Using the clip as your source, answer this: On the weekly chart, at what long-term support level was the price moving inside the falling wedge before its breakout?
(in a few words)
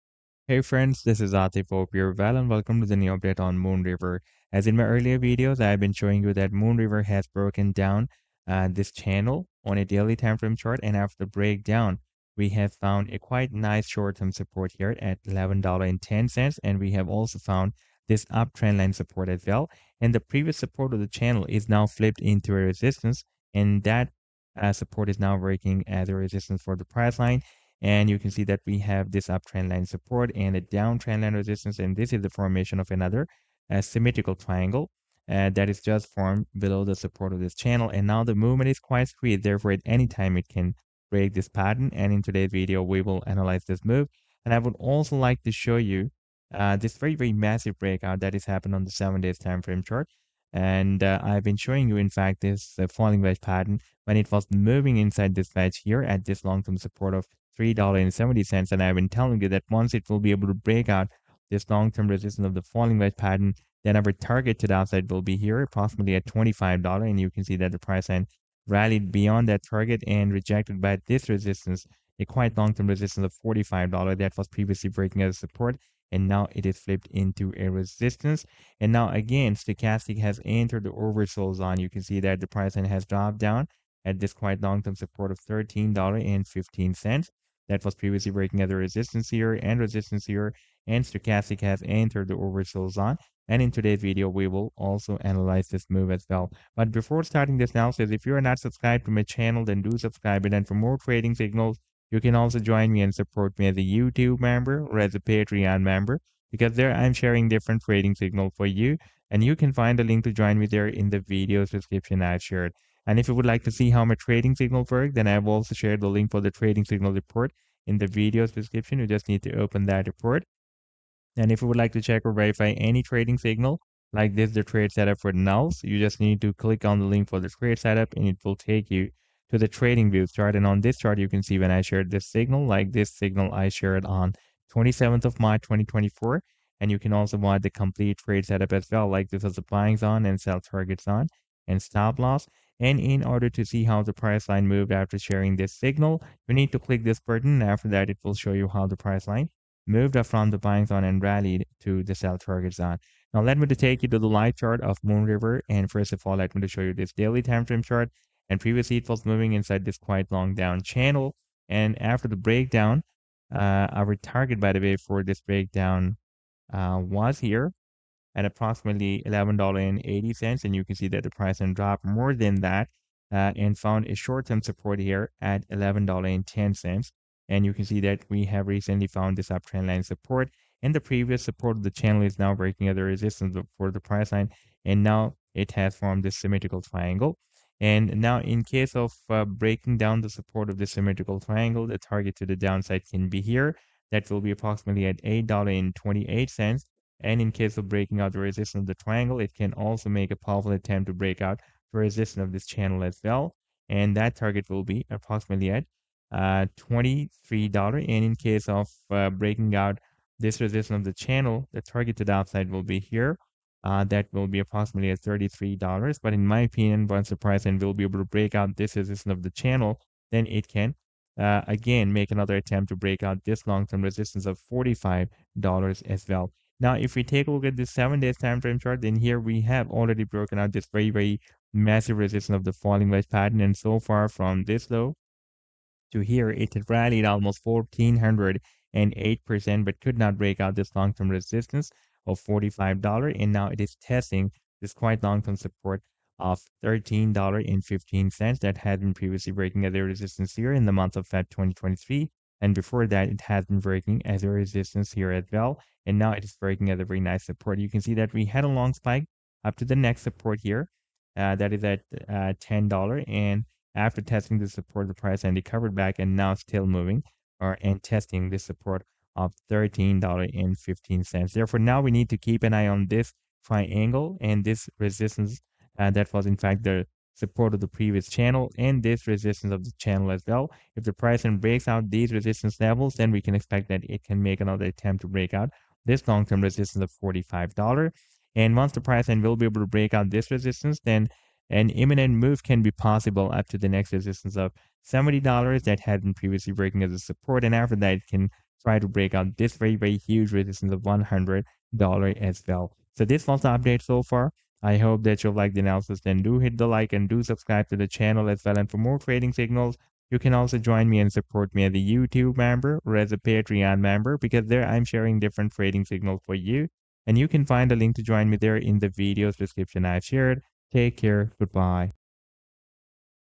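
$3.70.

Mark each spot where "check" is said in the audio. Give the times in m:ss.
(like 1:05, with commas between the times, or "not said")
2:02.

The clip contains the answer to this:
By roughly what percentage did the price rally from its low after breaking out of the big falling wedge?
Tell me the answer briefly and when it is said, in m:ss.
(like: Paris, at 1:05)
1408%, at 3:57.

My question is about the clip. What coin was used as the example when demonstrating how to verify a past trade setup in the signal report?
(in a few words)
NULS.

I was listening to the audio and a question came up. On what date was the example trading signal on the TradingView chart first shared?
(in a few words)
27th of March, 2024.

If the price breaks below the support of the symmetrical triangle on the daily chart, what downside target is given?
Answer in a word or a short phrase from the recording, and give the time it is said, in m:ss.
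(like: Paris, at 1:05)
$8.28, at 3:15.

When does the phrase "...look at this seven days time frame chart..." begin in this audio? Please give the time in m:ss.
3:47.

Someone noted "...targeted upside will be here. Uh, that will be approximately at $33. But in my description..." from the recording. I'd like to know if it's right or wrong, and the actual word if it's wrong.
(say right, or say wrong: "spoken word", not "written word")
wrong: "opinion", not "description".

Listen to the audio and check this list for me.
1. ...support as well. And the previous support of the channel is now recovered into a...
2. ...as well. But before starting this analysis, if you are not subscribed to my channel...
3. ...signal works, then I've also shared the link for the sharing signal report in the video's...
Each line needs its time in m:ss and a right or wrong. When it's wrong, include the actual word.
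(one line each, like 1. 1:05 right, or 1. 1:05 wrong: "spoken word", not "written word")
1. 0:18 wrong: "flipped", not "recovered"
2. 1:36 right
3. 1:54 wrong: "trading", not "sharing".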